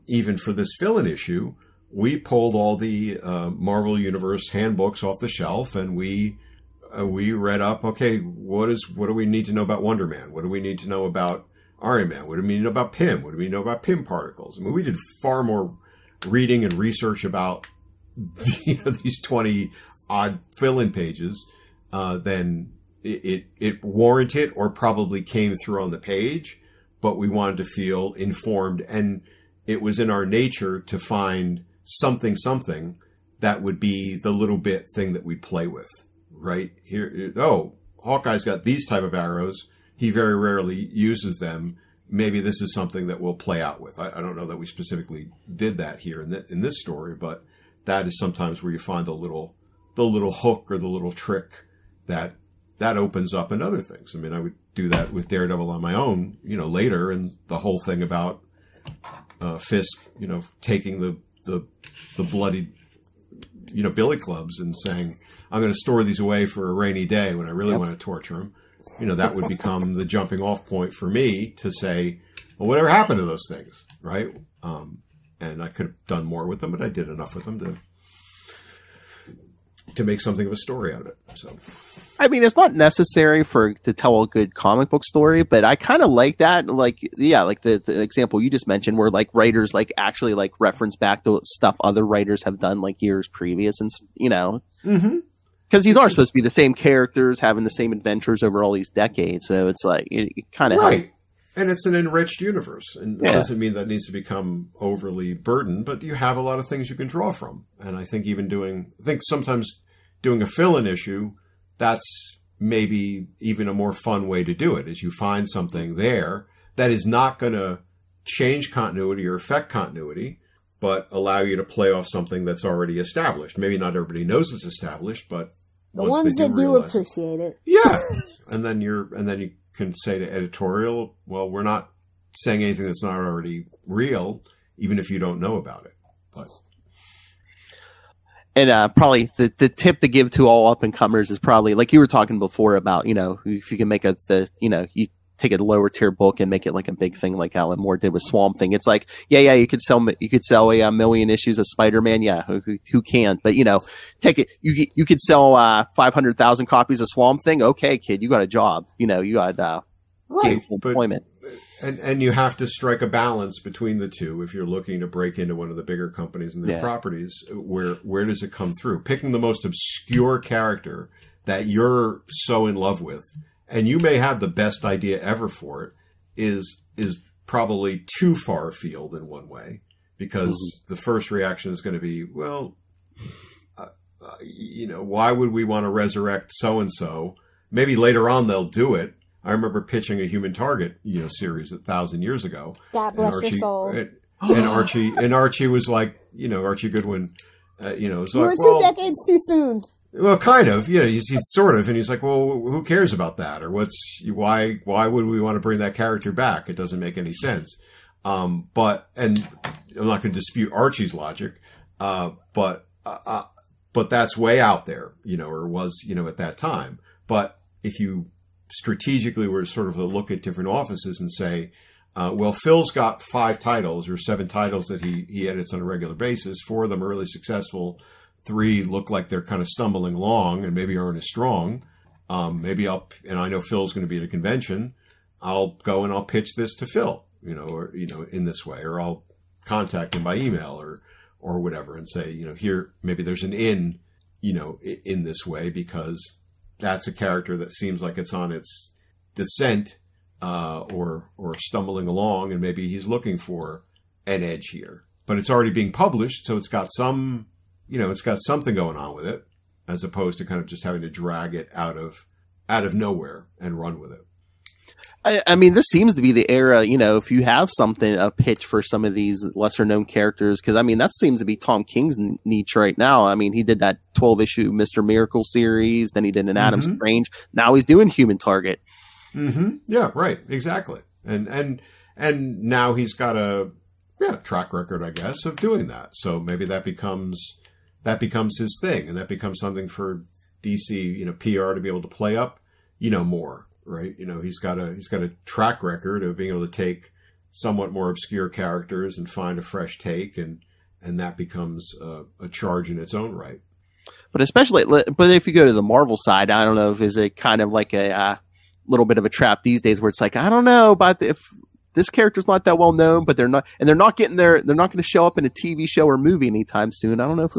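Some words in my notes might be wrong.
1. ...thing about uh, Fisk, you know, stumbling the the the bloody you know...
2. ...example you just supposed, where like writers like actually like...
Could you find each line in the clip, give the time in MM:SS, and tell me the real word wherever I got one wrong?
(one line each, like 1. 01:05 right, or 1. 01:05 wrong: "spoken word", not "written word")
1. 00:57 wrong: "taking", not "stumbling"
2. 01:27 wrong: "mentioned", not "supposed".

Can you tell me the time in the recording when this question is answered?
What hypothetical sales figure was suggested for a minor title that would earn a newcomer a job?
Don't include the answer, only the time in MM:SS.
02:35.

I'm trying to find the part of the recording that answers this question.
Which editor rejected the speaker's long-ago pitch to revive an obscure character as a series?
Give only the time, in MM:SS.
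03:16.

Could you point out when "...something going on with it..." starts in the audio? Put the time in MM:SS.
04:18.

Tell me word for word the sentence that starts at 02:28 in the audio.
It's like, yeah, yeah, you could sell you could sell a, a million issues of Spider Man.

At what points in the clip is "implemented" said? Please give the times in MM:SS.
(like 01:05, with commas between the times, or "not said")
not said.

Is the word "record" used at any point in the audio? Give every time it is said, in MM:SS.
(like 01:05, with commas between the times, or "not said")
04:44, 04:55.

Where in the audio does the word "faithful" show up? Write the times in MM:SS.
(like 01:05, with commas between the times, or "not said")
not said.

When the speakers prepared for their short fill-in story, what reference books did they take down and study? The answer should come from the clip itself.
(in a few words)
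Marvel Universe handbooks.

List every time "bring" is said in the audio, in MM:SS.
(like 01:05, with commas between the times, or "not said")
03:25.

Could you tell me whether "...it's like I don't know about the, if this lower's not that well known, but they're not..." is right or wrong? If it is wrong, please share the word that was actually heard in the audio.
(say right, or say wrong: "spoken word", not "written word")
wrong: "character", not "lower".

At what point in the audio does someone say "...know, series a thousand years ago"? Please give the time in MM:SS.
03:11.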